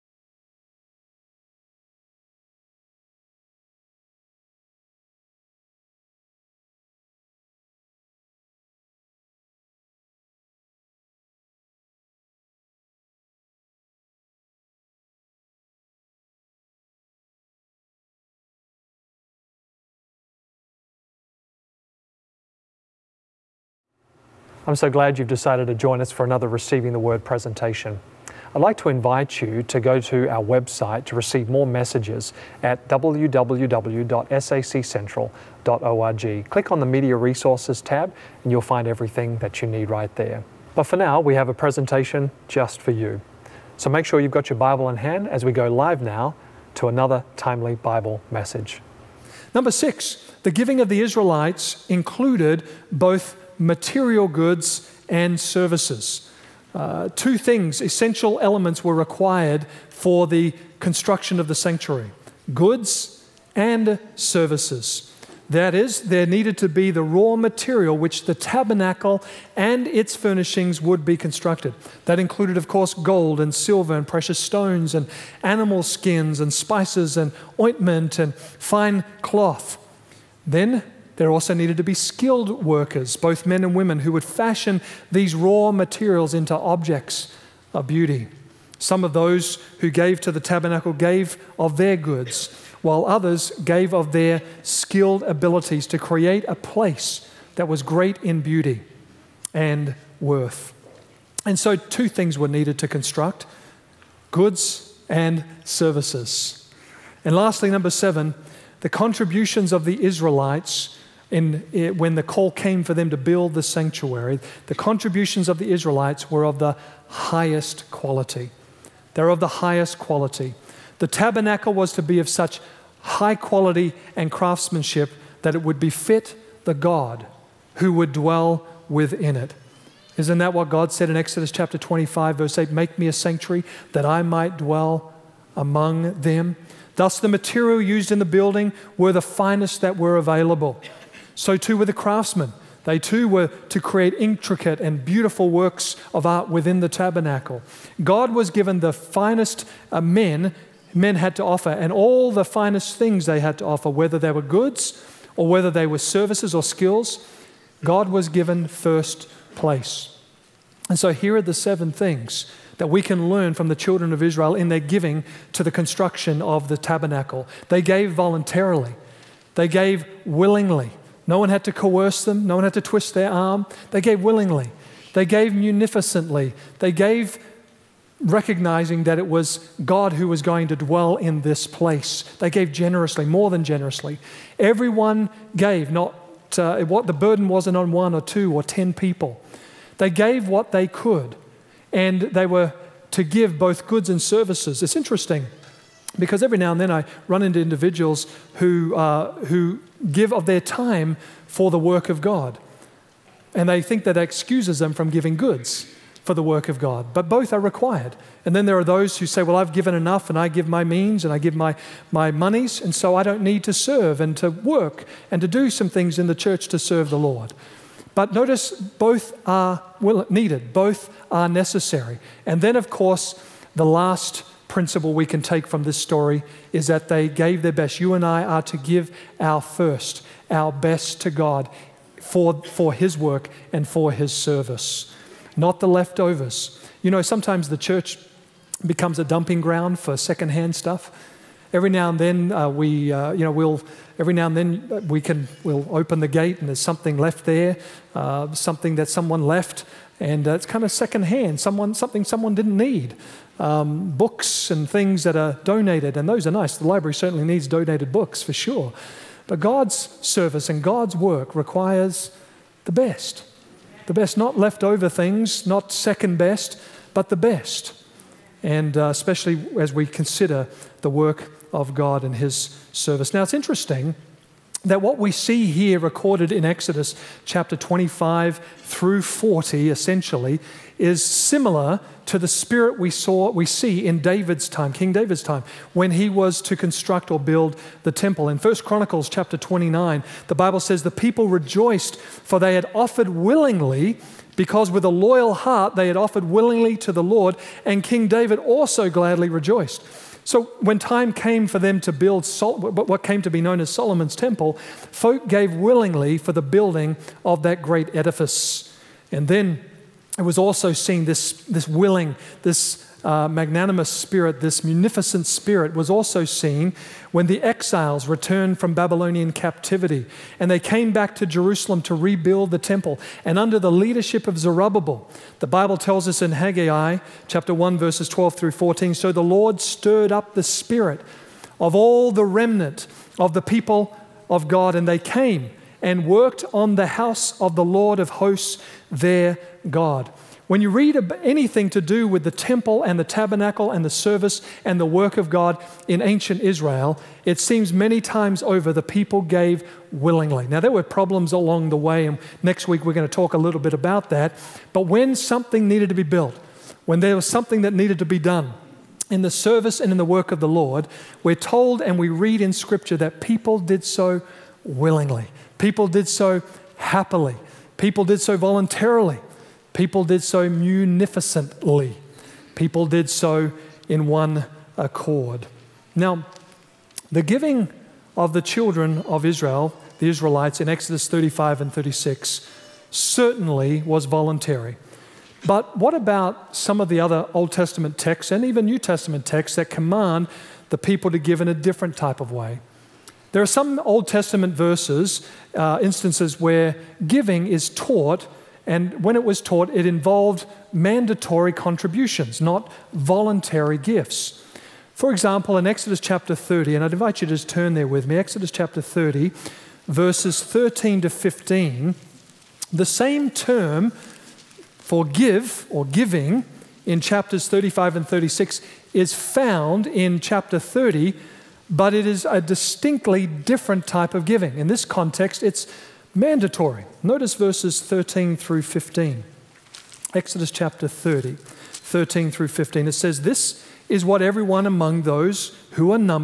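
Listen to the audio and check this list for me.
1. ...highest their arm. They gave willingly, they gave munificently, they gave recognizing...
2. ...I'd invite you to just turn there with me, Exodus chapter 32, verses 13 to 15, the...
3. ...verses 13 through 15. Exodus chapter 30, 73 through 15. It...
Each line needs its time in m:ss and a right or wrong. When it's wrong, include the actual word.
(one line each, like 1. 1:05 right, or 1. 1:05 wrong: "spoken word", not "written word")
1. 2:52 wrong: "twist", not "highest"
2. 6:47 wrong: "30", not "32"
3. 7:07 wrong: "13", not "73".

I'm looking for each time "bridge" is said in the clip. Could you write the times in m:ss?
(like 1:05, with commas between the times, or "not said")
not said.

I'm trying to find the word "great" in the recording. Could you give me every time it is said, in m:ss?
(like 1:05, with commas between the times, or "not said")
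1:37, 5:07.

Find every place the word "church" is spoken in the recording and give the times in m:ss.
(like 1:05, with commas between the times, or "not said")
3:36, 3:57.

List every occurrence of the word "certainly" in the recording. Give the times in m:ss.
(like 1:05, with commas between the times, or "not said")
4:17, 6:23.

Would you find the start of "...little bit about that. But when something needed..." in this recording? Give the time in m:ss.
5:53.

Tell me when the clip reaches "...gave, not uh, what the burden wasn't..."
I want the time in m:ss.
3:05.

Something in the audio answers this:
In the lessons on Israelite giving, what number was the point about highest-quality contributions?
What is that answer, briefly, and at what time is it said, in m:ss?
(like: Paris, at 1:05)
7, at 1:47.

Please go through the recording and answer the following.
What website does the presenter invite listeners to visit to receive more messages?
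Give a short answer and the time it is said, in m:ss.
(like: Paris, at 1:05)
www.saccentral.org, at 0:32.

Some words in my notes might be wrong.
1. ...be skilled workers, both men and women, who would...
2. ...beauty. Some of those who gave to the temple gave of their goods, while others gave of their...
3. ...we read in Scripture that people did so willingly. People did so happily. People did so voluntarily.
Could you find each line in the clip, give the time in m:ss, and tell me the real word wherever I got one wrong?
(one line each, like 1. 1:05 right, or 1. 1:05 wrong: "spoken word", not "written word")
1. 1:21 right
2. 1:27 wrong: "tabernacle", not "temple"
3. 6:02 right.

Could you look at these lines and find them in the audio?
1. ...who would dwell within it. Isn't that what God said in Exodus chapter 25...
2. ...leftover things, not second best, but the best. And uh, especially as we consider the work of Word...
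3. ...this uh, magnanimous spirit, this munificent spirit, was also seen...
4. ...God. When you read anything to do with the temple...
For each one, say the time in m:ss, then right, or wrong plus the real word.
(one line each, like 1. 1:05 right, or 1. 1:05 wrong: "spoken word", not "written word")
1. 2:07 right
2. 4:24 wrong: "God", not "Word"
3. 5:12 right
4. 5:39 right.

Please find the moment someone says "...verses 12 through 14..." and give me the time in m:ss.
5:27.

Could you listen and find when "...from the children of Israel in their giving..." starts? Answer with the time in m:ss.
2:43.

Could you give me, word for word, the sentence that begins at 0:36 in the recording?
Click on the Media Resources tab and you'll find everything that you need right there.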